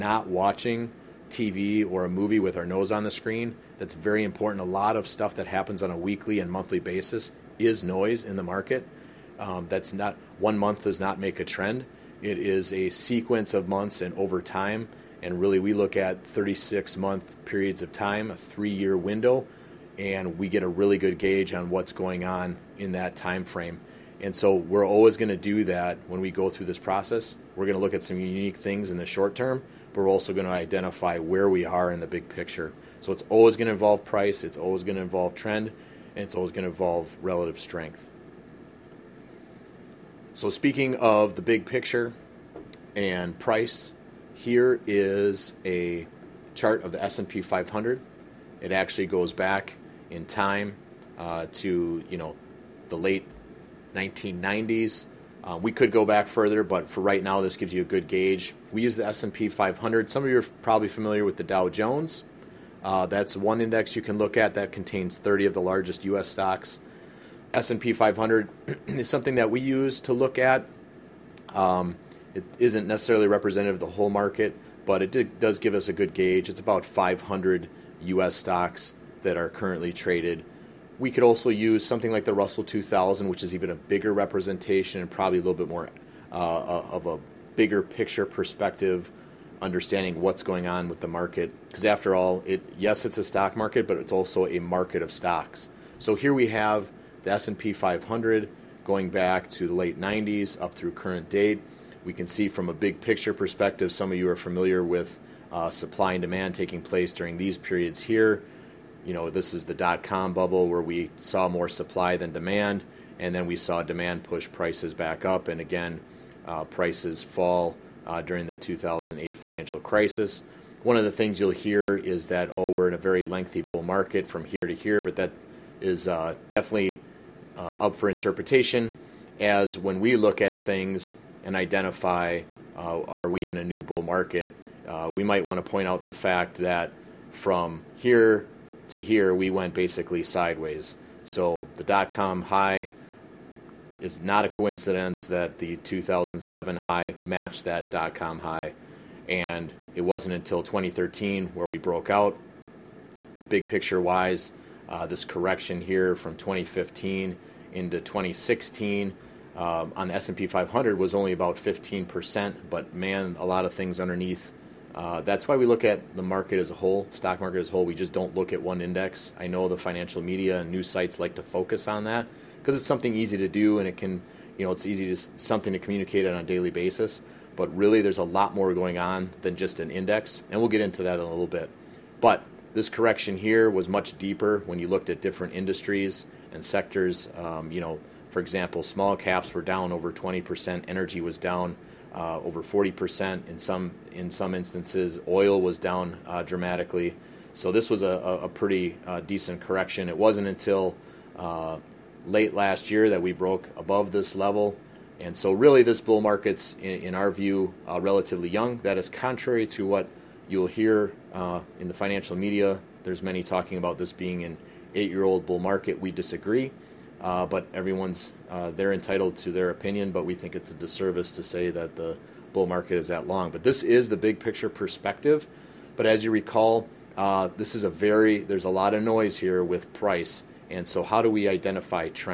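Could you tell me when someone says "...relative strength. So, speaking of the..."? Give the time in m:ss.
0:37.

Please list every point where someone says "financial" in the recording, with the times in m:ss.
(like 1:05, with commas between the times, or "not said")
1:59, 2:49, 3:31.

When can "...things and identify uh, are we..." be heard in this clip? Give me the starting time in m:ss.
2:10.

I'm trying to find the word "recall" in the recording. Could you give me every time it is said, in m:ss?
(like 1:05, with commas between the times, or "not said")
3:46.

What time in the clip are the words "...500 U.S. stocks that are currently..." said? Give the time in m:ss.
1:16.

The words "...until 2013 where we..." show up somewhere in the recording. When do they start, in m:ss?
2:30.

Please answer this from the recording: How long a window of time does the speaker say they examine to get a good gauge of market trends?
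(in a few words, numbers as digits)
36 months.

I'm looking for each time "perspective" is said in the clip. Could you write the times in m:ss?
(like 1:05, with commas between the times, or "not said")
1:28, 1:43, 3:44.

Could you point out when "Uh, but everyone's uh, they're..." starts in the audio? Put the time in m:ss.
3:37.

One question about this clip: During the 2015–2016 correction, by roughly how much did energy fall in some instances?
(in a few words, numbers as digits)
over 40%.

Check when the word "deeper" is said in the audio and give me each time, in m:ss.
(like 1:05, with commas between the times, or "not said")
3:04.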